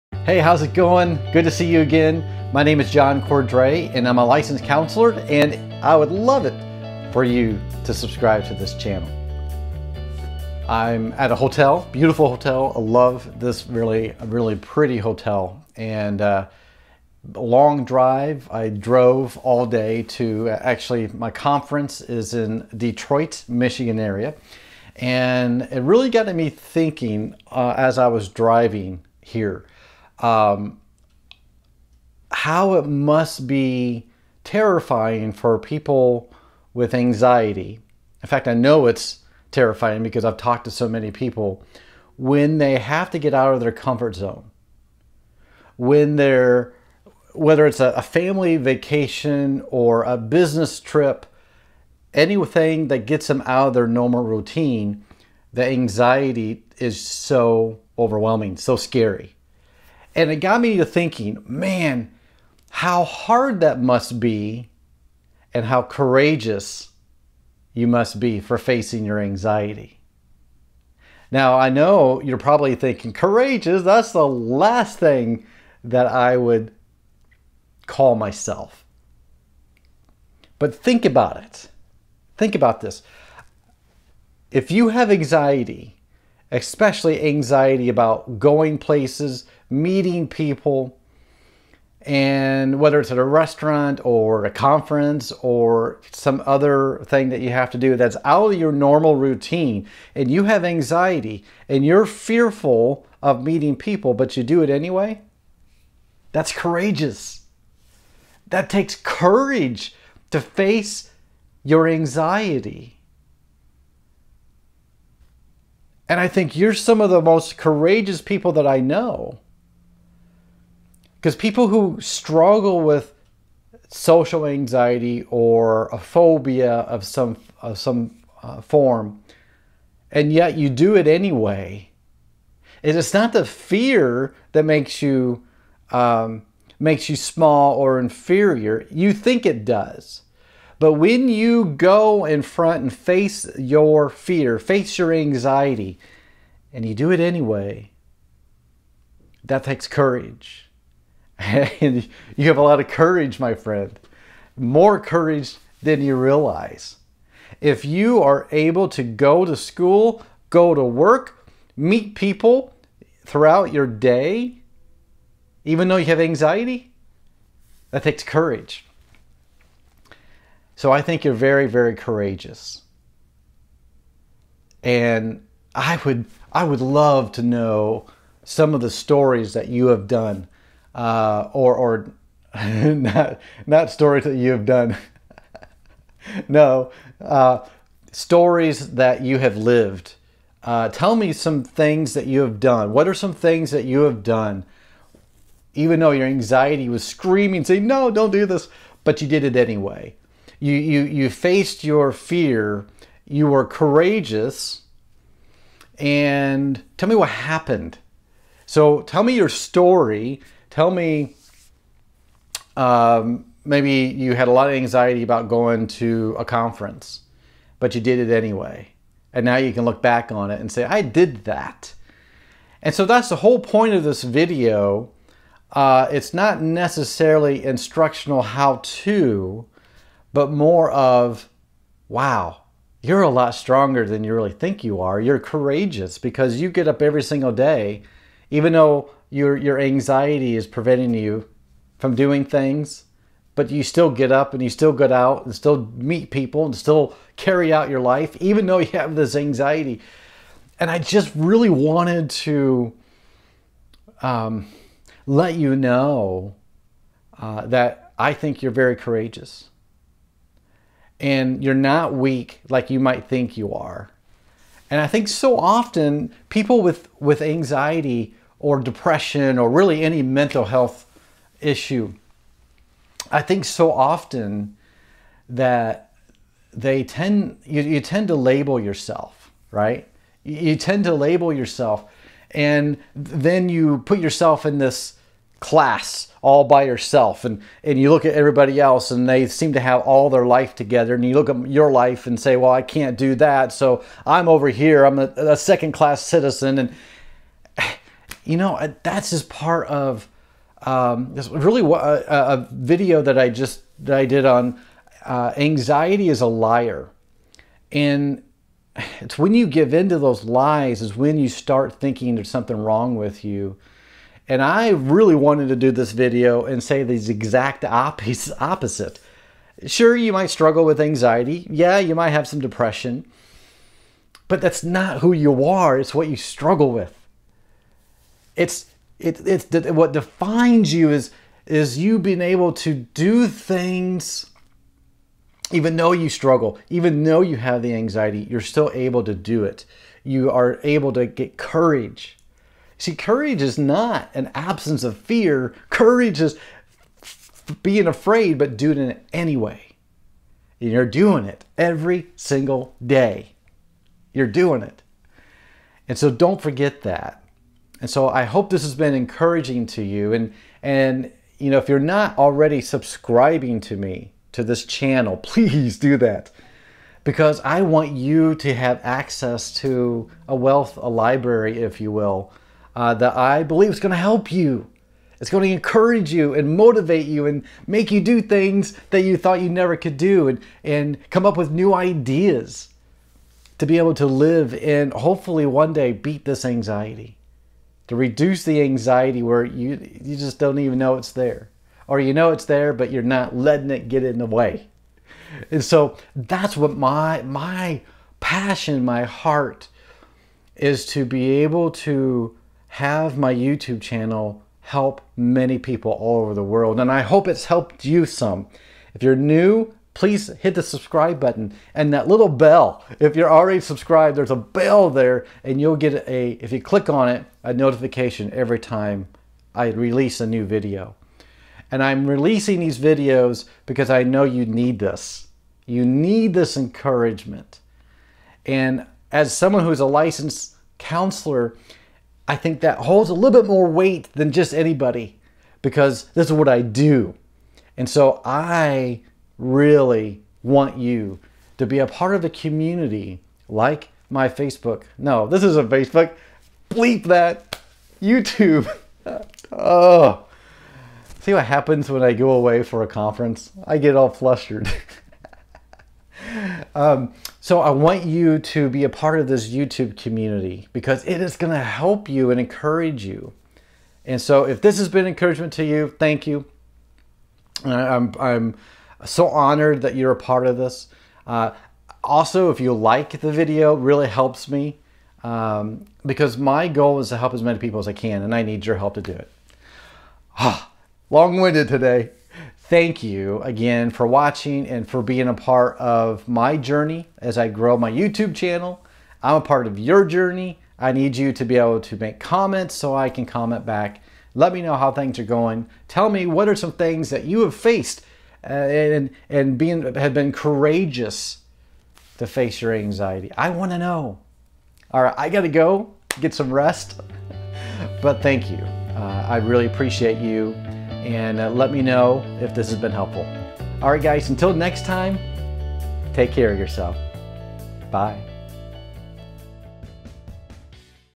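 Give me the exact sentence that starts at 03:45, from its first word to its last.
Uh, it's not necessarily instructional how to, but more of, wow, you're a lot stronger than you really think you are.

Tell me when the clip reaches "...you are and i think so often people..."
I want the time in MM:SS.
04:23.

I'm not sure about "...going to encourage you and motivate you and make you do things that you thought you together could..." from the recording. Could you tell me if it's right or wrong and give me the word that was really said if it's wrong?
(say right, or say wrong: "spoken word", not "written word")
wrong: "never", not "together".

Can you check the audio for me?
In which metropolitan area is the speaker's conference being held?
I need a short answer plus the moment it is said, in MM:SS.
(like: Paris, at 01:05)
Detroit, Michigan, at 00:22.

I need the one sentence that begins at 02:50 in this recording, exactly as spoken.
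So I think you're very, very courageous.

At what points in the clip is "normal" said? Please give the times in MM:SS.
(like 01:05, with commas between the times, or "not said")
00:53, 01:38.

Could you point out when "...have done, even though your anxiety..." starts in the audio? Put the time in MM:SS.
03:14.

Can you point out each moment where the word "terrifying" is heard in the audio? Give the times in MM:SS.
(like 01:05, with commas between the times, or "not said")
00:34, 00:39.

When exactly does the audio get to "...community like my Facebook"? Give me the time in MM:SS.
07:22.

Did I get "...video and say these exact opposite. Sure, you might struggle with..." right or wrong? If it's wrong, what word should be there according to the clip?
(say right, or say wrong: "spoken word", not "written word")
right.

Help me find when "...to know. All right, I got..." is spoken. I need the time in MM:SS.
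08:23.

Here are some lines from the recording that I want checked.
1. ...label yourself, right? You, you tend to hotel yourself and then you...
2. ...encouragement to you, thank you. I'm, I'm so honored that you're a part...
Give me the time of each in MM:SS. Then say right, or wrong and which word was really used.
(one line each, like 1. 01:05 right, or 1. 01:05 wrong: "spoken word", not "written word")
1. 04:38 wrong: "label", not "hotel"
2. 07:45 right.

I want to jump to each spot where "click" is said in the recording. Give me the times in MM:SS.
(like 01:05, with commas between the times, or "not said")
06:56.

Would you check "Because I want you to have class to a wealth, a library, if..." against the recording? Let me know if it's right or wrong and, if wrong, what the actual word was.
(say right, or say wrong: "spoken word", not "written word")
wrong: "access", not "class".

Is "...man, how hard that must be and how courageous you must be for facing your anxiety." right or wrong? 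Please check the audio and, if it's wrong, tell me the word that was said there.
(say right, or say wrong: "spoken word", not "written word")
right.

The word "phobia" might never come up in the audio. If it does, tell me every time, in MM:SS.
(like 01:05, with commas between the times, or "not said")
02:05.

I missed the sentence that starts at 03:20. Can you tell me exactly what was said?
You you you faced your fear.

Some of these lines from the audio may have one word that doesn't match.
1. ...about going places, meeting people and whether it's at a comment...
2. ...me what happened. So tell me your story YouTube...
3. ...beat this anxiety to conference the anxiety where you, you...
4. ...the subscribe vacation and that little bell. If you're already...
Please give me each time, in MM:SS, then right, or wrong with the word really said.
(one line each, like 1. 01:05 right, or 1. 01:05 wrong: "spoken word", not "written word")
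1. 01:27 wrong: "restaurant", not "comment"
2. 03:27 wrong: "Tell", not "YouTube"
3. 06:26 wrong: "reduce", not "conference"
4. 06:50 wrong: "button", not "vacation".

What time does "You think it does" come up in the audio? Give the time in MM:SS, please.
02:18.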